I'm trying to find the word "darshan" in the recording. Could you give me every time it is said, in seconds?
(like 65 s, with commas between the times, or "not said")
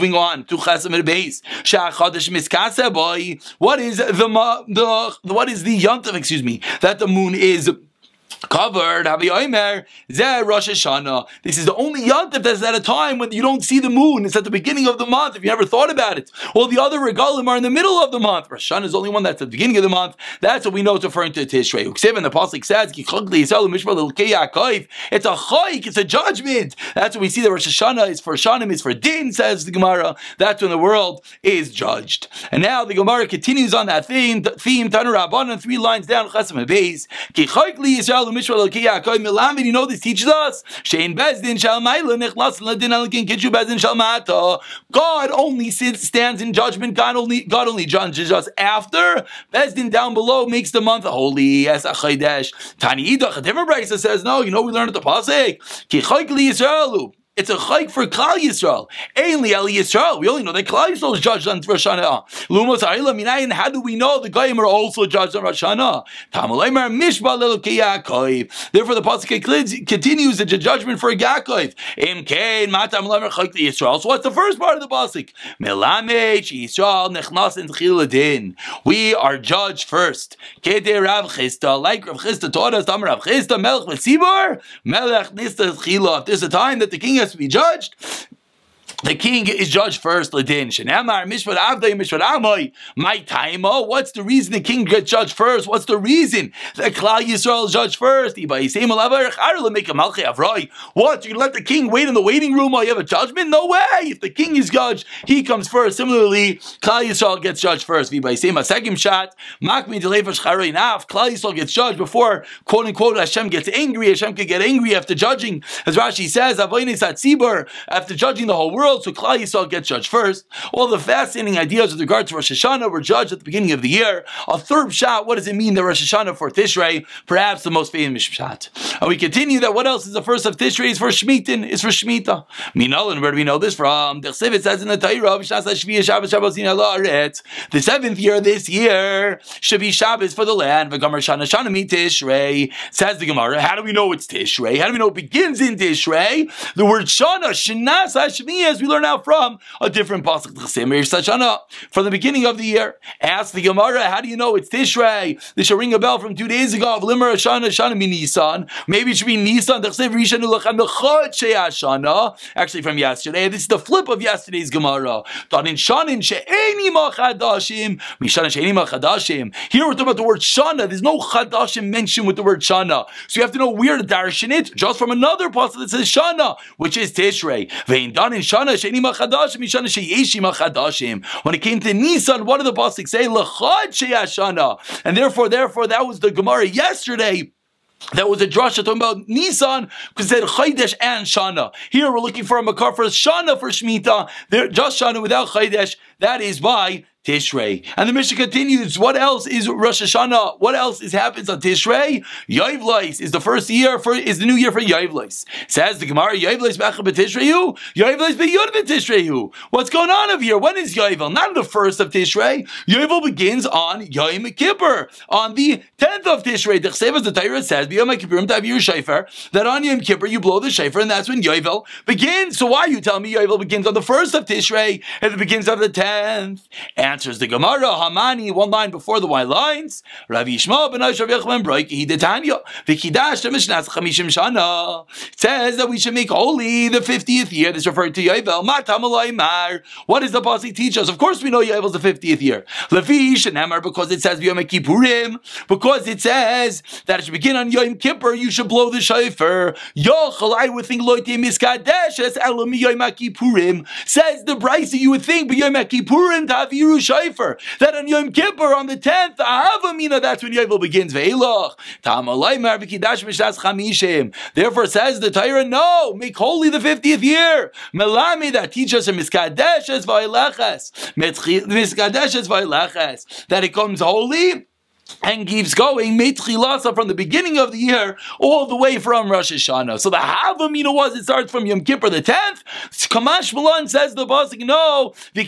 174 s.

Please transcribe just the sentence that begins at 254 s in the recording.
Says the Braisa, you would think, but Yom Kippurim, Taviru shofar.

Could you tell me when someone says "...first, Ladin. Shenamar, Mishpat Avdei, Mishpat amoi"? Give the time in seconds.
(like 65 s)
90 s.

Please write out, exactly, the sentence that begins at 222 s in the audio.
So why are you telling me Yoivl begins on the first of Tishrei and it begins on the tenth?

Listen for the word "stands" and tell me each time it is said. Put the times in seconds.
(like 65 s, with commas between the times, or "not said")
45 s.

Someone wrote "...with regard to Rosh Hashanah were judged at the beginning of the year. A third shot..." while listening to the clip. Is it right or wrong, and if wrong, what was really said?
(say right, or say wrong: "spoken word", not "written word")
right.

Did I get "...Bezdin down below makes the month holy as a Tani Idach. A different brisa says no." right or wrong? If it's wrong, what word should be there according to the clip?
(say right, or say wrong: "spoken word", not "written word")
right.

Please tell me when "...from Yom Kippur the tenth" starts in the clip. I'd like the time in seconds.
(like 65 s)
281 s.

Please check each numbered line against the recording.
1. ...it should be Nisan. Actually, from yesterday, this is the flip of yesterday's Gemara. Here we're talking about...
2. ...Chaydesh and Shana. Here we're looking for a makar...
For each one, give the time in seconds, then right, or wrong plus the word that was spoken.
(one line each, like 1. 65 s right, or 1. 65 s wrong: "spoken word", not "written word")
1. 159 s right
2. 190 s right.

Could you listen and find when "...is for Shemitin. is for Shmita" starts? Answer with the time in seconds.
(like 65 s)
130 s.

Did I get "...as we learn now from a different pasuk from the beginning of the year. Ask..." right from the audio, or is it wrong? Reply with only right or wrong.
right.